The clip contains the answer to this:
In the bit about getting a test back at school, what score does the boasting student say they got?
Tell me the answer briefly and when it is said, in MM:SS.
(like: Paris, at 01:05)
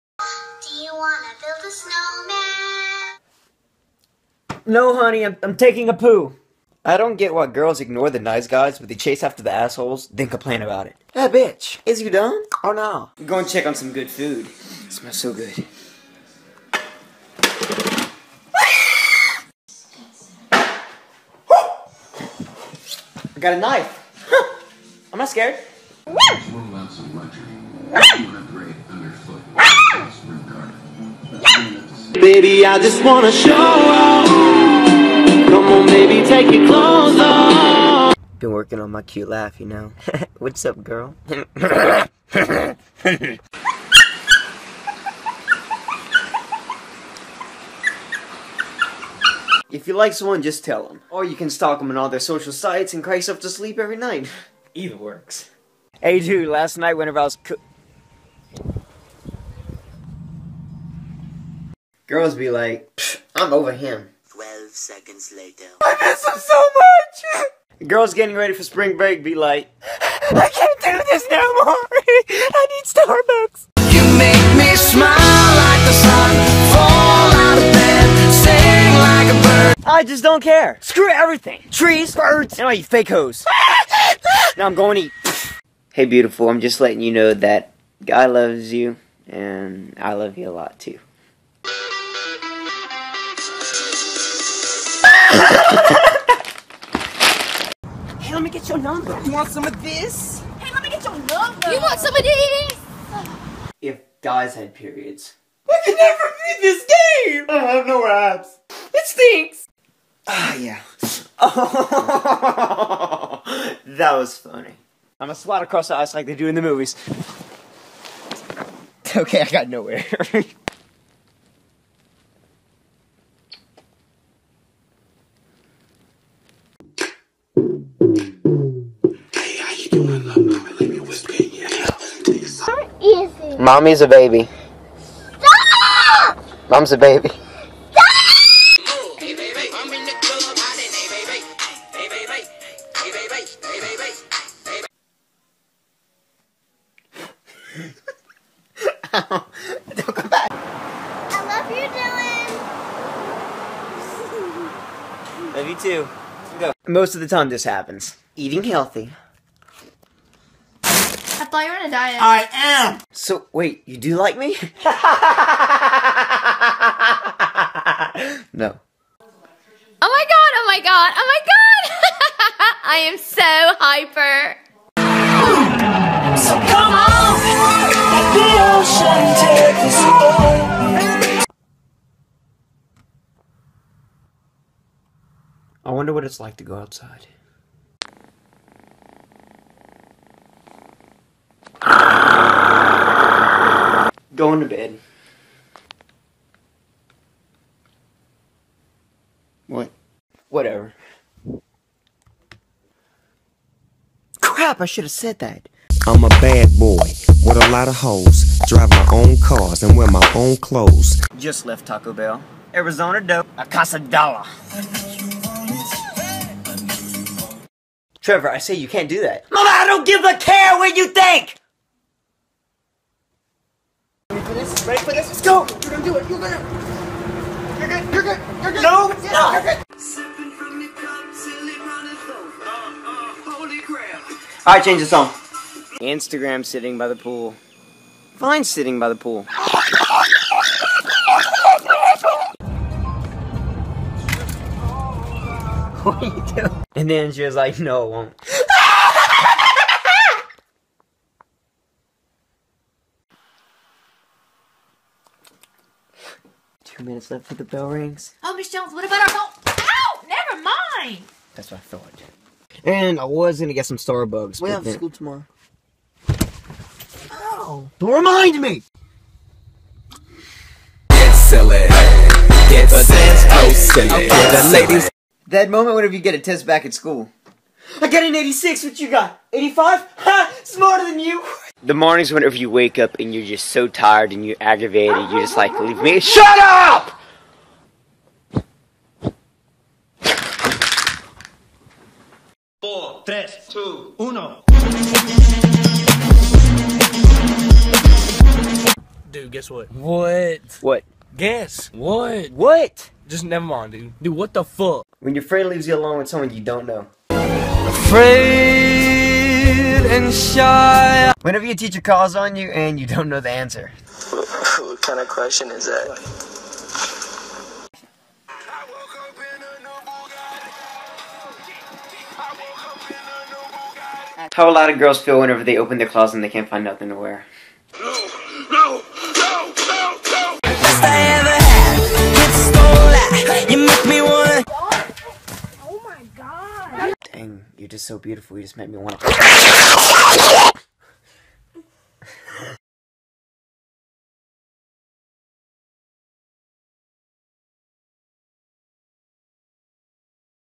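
86, at 04:38.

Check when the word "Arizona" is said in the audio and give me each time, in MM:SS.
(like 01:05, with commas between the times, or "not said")
03:32.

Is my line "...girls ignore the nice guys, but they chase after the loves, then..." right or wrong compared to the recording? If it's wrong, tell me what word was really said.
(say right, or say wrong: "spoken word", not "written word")
wrong: "assholes", not "loves".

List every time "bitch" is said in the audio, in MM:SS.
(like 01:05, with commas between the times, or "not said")
00:11.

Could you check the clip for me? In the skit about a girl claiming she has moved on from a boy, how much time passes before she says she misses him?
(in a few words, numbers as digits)
12 seconds.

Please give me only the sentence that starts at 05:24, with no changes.
how a lot of girls feel whenever they open their closet and they can't find nothing to wear.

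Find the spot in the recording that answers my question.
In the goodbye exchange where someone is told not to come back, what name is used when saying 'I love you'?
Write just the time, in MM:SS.
02:31.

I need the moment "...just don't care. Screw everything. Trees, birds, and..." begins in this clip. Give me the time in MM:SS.
01:20.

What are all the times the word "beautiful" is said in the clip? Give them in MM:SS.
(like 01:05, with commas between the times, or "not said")
01:26, 05:38.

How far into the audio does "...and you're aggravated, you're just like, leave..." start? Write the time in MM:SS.
04:44.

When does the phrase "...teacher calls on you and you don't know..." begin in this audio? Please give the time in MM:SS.
05:11.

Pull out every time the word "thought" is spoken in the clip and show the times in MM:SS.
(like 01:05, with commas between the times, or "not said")
02:41, 04:21.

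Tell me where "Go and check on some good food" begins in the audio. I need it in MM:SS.
00:13.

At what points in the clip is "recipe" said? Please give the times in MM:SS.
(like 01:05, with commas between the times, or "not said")
not said.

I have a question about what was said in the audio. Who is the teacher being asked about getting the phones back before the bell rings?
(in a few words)
Miss Jones.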